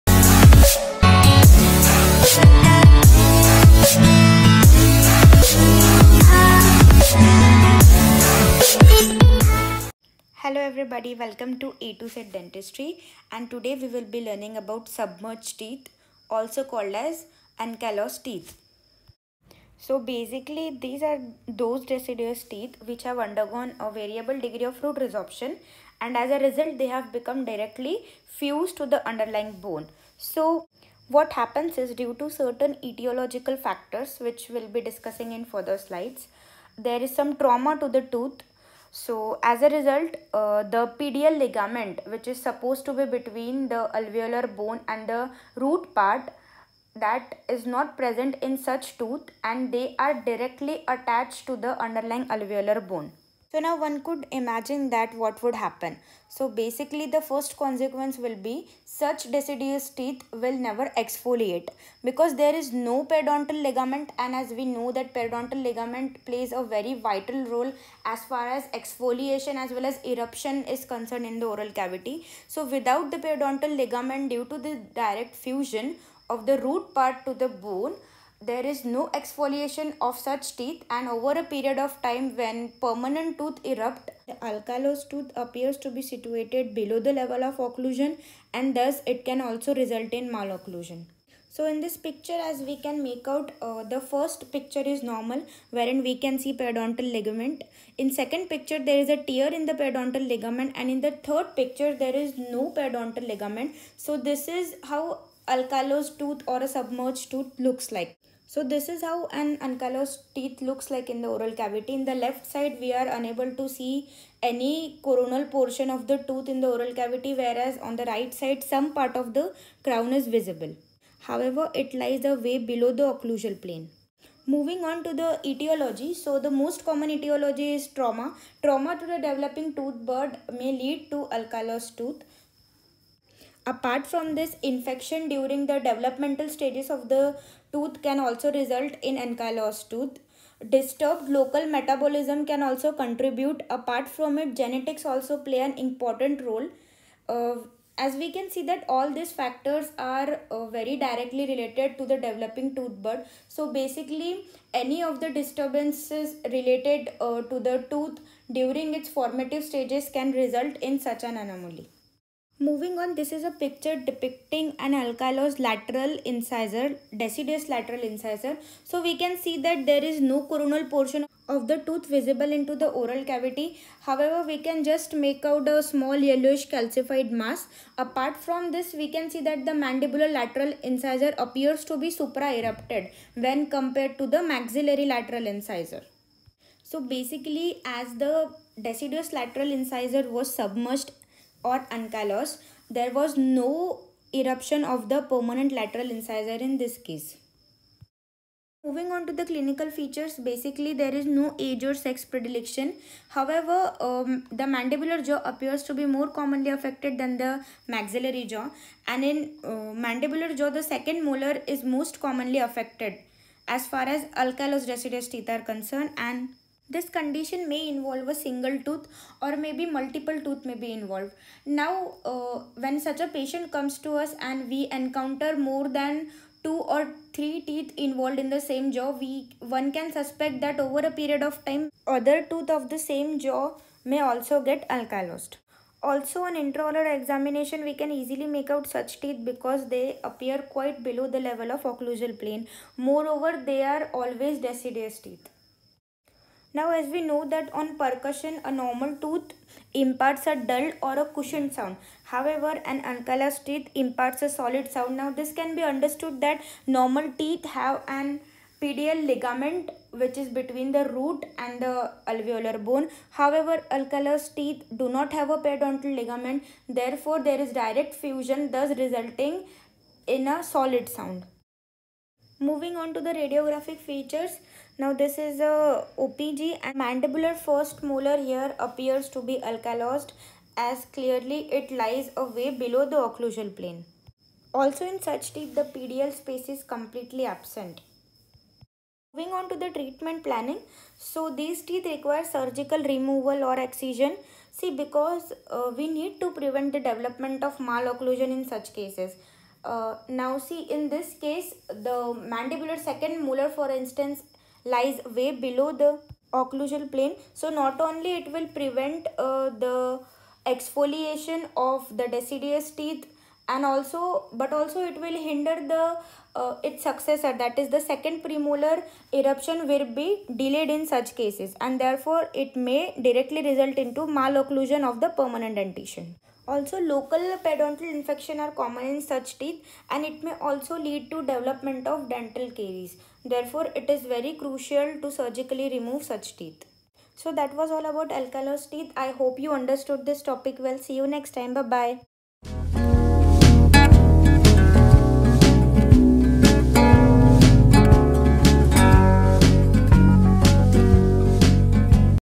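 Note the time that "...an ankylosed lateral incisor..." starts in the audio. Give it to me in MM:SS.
02:44.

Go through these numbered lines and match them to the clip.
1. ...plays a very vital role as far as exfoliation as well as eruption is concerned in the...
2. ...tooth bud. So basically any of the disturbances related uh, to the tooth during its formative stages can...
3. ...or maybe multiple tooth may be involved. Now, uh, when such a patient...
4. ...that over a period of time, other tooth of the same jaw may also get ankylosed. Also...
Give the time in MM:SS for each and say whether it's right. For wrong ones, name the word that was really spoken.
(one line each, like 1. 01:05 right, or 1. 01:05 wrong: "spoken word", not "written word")
1. 01:06 right
2. 02:32 right
3. 03:39 right
4. 03:50 right.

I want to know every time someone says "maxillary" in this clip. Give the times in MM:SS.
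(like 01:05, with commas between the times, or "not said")
03:04, 03:27.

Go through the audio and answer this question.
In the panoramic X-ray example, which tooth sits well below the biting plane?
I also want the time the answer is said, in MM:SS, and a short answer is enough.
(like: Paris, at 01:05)
Mandibular first molar, at 04:36.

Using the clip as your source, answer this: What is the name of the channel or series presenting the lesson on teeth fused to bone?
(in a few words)
A to Z Dentistry.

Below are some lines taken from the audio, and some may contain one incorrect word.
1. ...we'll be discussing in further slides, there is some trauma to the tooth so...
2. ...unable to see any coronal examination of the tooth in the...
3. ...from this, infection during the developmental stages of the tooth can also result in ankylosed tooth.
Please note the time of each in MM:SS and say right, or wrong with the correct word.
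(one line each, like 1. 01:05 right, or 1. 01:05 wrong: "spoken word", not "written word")
1. 00:34 right
2. 01:53 wrong: "portion", not "examination"
3. 02:14 right.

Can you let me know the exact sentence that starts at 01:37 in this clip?
In second picture there is a tear in the periodontal ligament and in the third picture there is no periodontal ligament.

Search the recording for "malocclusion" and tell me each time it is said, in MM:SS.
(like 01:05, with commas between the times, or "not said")
01:30, 04:57, 05:24.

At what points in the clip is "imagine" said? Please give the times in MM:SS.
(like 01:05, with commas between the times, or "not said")
00:54.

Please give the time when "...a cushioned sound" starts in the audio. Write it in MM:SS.
04:11.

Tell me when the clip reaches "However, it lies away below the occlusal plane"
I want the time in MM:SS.
02:01.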